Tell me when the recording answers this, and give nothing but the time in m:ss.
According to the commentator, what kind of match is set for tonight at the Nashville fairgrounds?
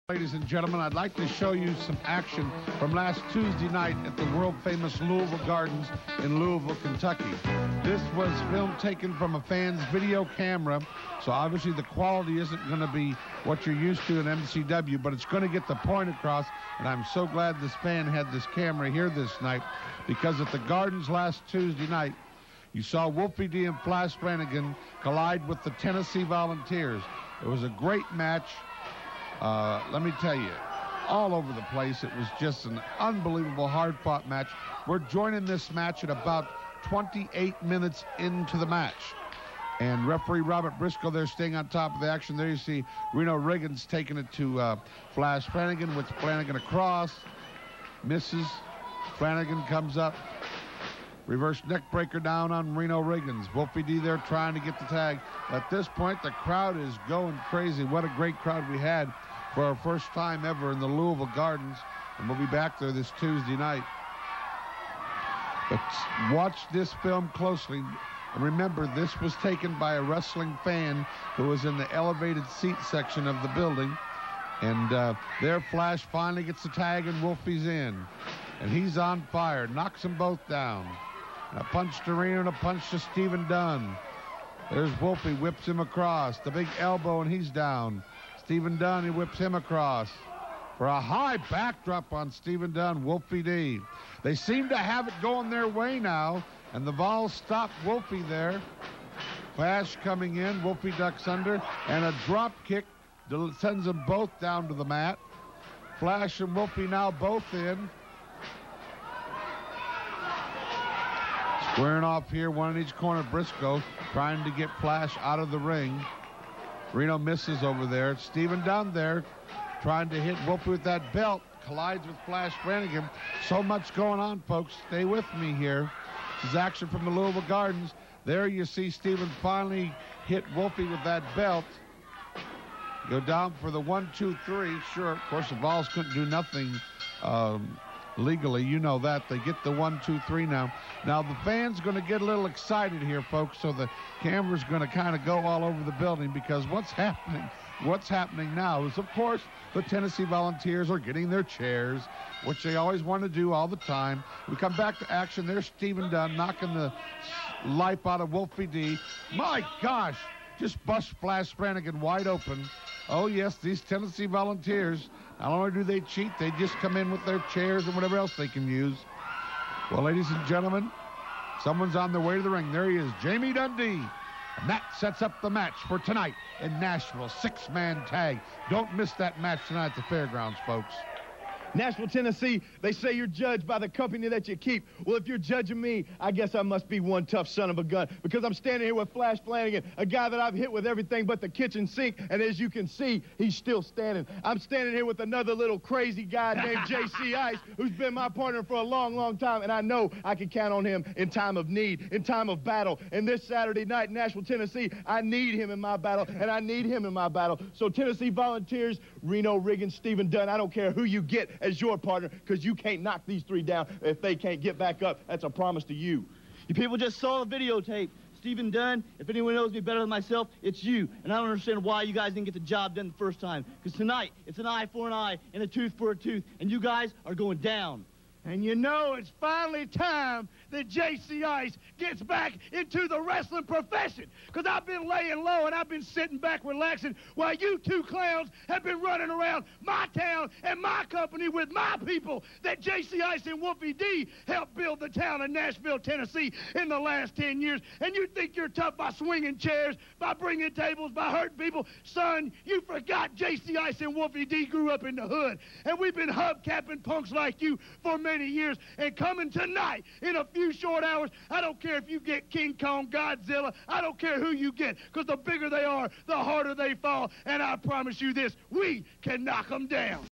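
2:57.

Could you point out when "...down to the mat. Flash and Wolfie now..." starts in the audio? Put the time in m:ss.
1:44.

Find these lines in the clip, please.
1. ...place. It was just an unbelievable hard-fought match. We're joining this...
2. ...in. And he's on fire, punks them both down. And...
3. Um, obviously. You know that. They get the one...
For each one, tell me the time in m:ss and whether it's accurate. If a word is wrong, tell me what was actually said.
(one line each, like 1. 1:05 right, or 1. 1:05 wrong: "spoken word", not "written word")
1. 0:31 right
2. 1:17 wrong: "knocks", not "punks"
3. 2:17 wrong: "legally", not "obviously".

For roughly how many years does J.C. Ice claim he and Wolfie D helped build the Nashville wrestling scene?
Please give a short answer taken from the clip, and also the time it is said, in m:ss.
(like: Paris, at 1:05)
10 years, at 4:07.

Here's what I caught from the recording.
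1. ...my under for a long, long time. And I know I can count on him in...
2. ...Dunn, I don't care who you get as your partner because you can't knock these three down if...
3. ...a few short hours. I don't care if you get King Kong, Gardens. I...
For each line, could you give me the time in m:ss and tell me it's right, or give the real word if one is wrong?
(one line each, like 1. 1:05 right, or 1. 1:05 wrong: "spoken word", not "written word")
1. 3:18 wrong: "partner", not "under"
2. 3:30 right
3. 4:20 wrong: "Godzilla", not "Gardens".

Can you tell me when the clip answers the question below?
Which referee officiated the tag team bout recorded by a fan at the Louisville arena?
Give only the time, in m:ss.
0:40.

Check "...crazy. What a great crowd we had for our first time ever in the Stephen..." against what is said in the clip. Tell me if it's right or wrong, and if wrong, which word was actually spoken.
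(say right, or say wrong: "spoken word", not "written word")
wrong: "Louisville", not "Stephen".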